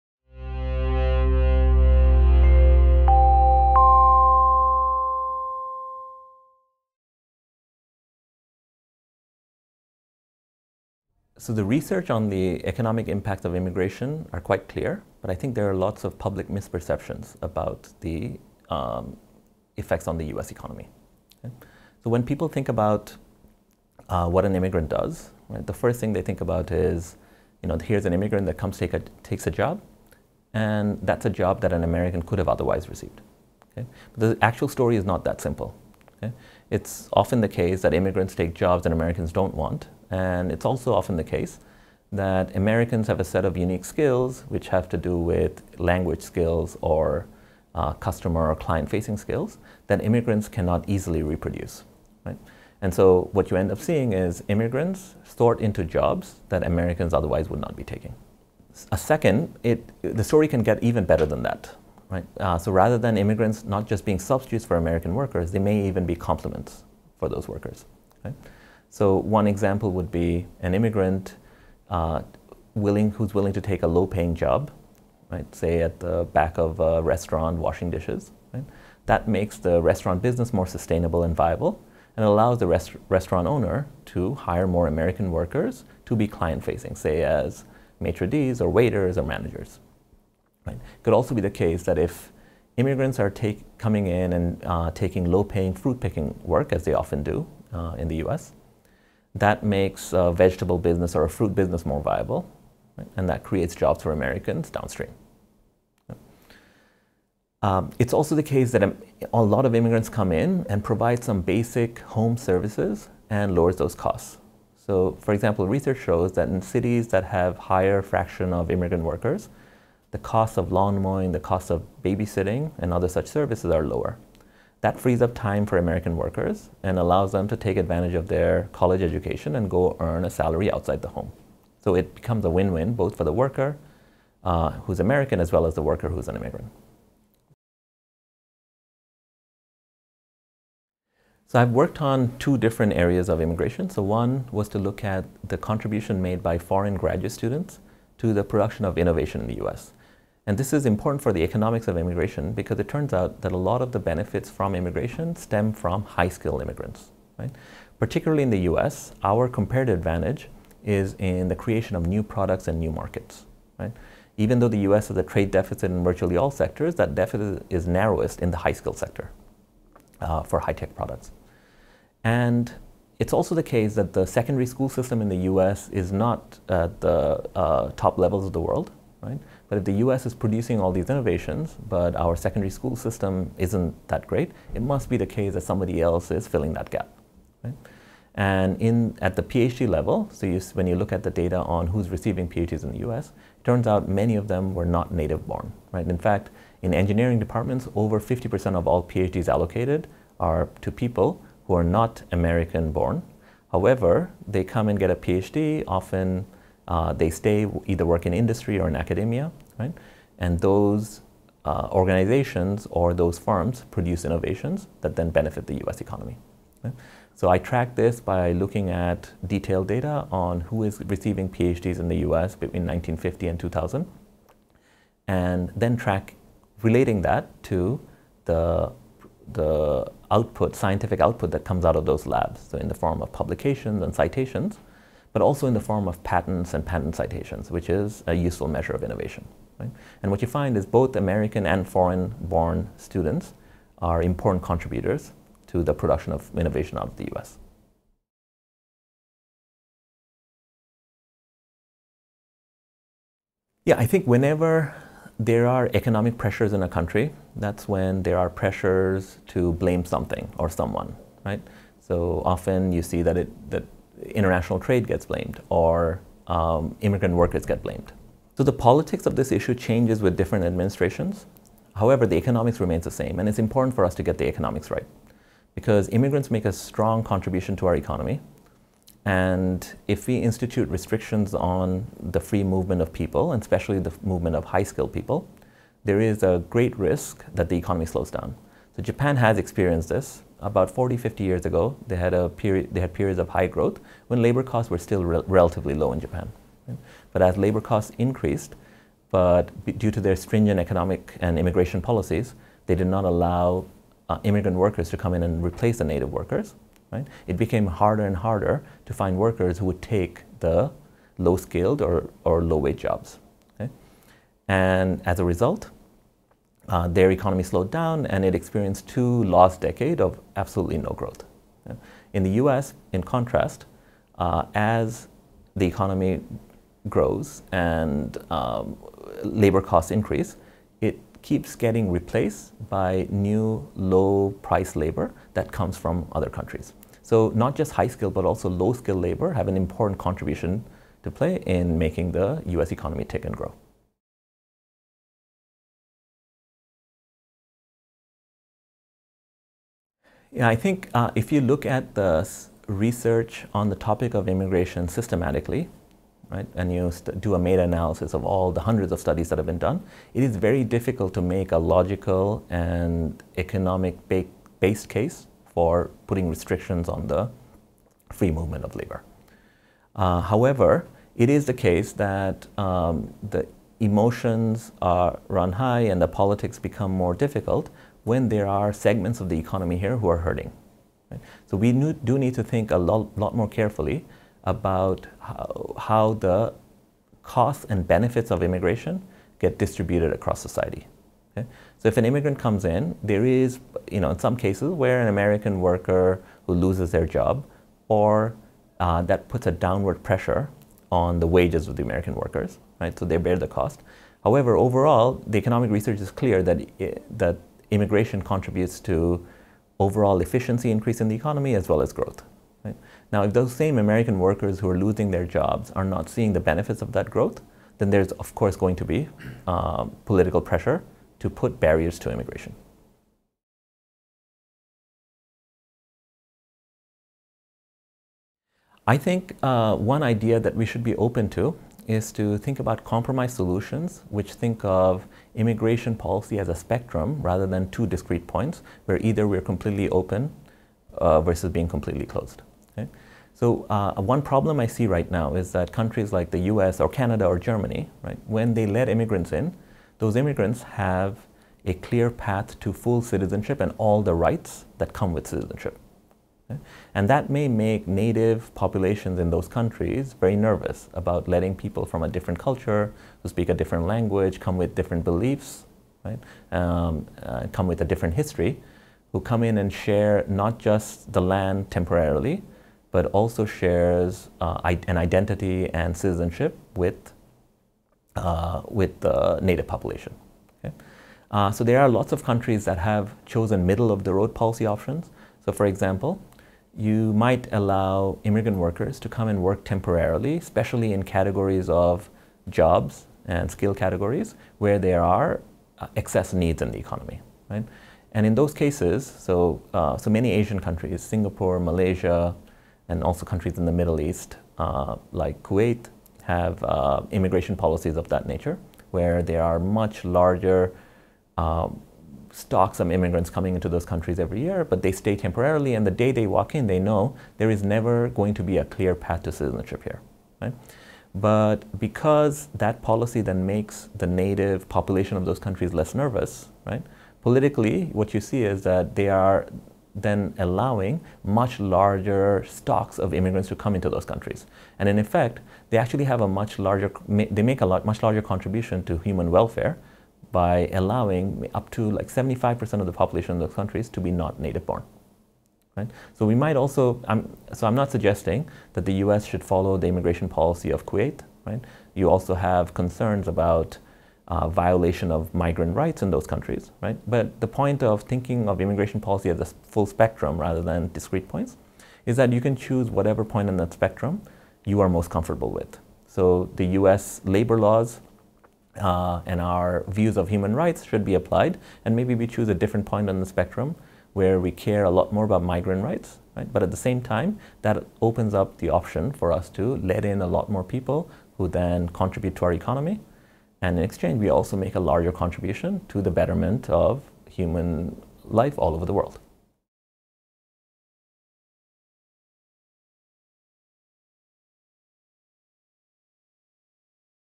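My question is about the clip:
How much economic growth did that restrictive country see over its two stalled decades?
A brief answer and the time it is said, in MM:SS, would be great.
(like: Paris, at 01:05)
absolutely no growth, at 05:20.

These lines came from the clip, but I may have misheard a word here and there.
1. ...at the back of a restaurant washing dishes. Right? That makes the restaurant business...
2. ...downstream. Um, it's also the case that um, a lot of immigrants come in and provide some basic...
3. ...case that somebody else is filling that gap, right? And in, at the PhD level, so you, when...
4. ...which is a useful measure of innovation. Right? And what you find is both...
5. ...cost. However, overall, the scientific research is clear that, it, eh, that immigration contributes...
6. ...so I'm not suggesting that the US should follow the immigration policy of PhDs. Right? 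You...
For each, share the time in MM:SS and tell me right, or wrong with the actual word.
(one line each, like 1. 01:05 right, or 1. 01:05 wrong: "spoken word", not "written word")
1. 01:15 right
2. 01:44 right
3. 03:05 right
4. 03:57 right
5. 06:43 wrong: "economic", not "scientific"
6. 09:07 wrong: "Kuwait", not "PhDs".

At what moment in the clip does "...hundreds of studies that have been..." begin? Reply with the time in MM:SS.
05:58.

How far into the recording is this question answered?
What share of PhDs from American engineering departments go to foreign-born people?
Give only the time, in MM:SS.
03:17.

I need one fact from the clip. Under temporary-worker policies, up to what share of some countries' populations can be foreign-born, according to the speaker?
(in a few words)
75%.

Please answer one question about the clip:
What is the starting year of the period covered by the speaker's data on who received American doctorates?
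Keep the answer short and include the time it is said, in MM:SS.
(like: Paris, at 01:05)
1950, at 03:42.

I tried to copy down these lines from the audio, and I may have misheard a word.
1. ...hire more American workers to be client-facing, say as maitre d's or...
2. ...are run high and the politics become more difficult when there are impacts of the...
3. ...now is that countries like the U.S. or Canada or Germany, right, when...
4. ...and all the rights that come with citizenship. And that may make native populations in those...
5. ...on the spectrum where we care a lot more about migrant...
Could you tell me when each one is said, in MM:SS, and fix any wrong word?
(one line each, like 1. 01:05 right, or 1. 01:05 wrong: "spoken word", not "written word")
1. 01:24 right
2. 06:15 wrong: "segments", not "impacts"
3. 07:25 right
4. 07:33 right
5. 09:33 right.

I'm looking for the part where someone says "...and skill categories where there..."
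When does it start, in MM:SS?
08:13.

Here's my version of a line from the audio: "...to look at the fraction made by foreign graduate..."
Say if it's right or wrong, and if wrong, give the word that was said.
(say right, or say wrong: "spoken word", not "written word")
wrong: "contribution", not "fraction".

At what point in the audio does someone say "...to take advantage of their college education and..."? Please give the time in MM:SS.
02:07.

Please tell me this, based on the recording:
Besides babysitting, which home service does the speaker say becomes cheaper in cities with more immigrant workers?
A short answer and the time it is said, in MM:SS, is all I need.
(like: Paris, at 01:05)
lawn mowing, at 02:00.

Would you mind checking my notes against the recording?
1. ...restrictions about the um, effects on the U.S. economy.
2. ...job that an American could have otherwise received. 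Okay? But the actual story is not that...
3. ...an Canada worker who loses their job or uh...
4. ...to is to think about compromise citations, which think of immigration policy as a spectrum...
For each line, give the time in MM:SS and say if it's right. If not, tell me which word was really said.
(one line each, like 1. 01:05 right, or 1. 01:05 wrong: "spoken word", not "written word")
1. 00:16 wrong: "misperceptions", not "restrictions"
2. 00:31 right
3. 06:35 wrong: "American", not "Canada"
4. 07:11 wrong: "solutions", not "citations".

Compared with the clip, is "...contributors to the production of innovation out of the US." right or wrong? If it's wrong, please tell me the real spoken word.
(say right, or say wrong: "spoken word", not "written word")
right.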